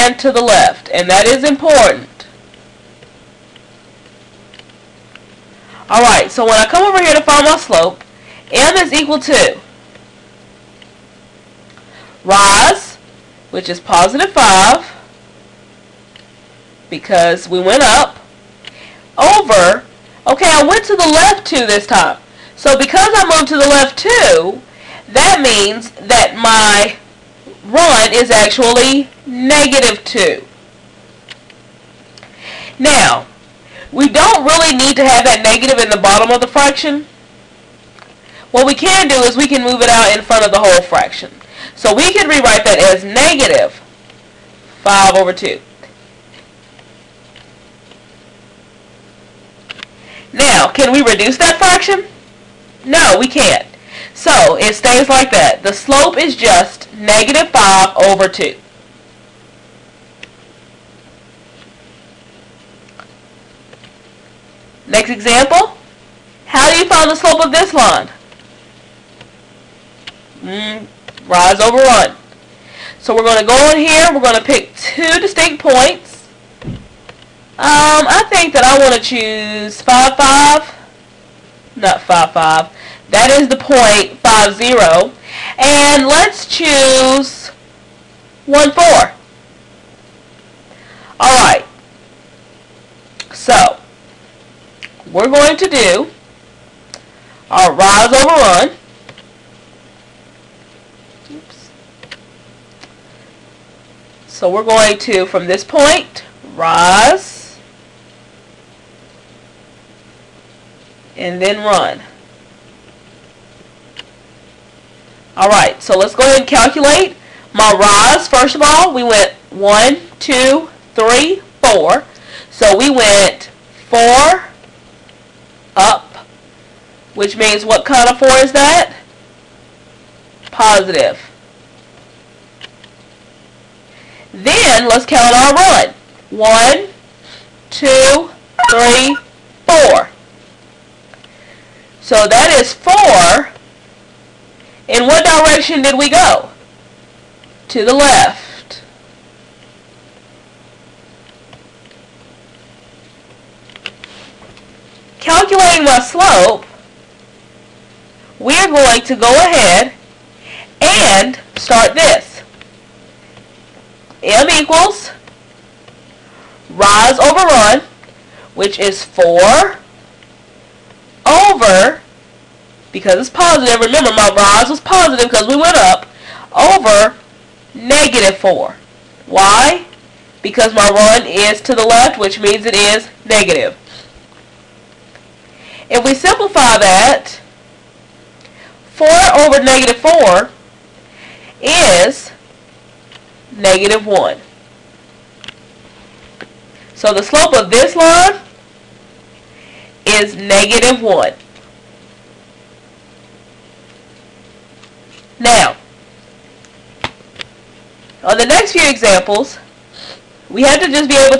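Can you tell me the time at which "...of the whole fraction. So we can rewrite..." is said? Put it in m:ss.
0:40.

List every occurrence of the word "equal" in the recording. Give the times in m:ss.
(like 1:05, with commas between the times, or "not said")
0:08, 2:44.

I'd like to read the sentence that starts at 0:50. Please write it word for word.
Now, can we reduce that fraction?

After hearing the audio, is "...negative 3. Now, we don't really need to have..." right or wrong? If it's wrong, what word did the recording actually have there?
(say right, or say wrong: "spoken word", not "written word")
wrong: "2", not "3".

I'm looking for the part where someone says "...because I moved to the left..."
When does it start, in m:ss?
0:22.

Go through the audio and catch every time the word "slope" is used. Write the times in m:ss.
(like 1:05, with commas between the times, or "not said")
0:07, 0:55, 1:07, 2:35, 3:17.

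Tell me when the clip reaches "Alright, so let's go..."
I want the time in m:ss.
1:55.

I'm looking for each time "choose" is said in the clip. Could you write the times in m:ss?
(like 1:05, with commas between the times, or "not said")
1:18, 1:26.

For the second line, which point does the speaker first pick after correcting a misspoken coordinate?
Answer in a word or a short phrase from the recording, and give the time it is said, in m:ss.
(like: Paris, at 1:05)
(5, 0), at 1:24.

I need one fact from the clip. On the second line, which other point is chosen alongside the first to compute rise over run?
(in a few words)
(1, 4).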